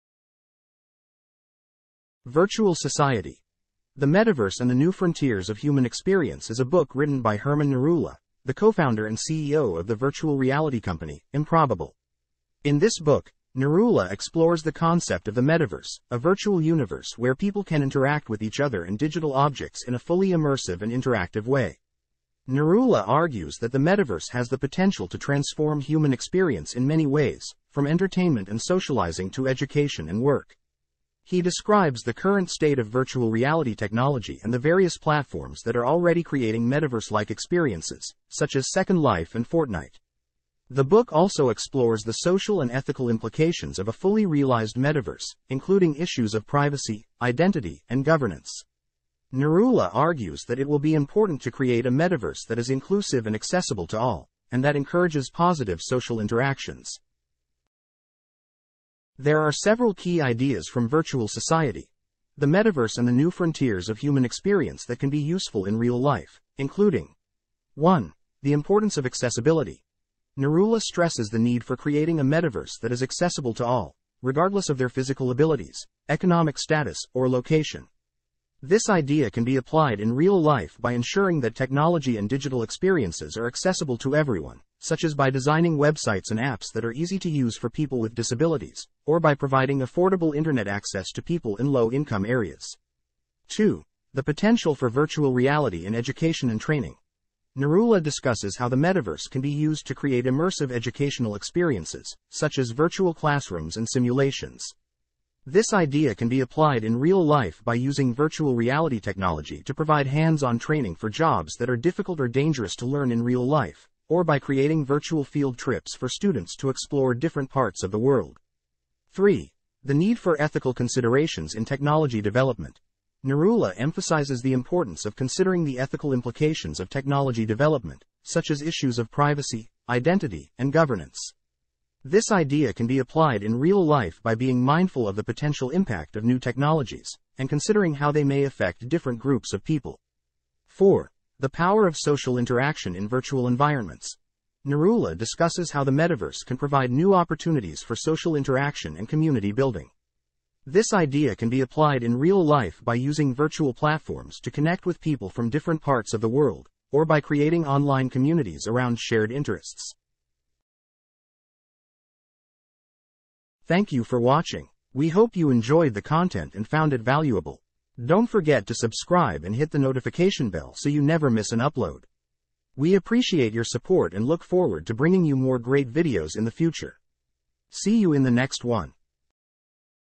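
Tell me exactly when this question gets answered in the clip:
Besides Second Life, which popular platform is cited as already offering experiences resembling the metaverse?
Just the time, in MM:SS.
00:39.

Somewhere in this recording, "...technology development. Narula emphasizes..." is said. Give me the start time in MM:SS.
02:01.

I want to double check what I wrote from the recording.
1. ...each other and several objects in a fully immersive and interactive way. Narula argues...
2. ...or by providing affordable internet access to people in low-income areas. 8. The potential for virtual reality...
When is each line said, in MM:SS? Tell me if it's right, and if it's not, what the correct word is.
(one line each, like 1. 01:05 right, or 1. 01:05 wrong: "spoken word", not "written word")
1. 00:18 wrong: "digital", not "several"
2. 01:29 wrong: "2", not "8".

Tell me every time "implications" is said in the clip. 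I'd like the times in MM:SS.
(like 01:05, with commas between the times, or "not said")
00:43, 02:06.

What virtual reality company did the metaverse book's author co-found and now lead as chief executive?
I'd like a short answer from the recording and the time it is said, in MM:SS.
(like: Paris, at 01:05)
Improbable, at 00:11.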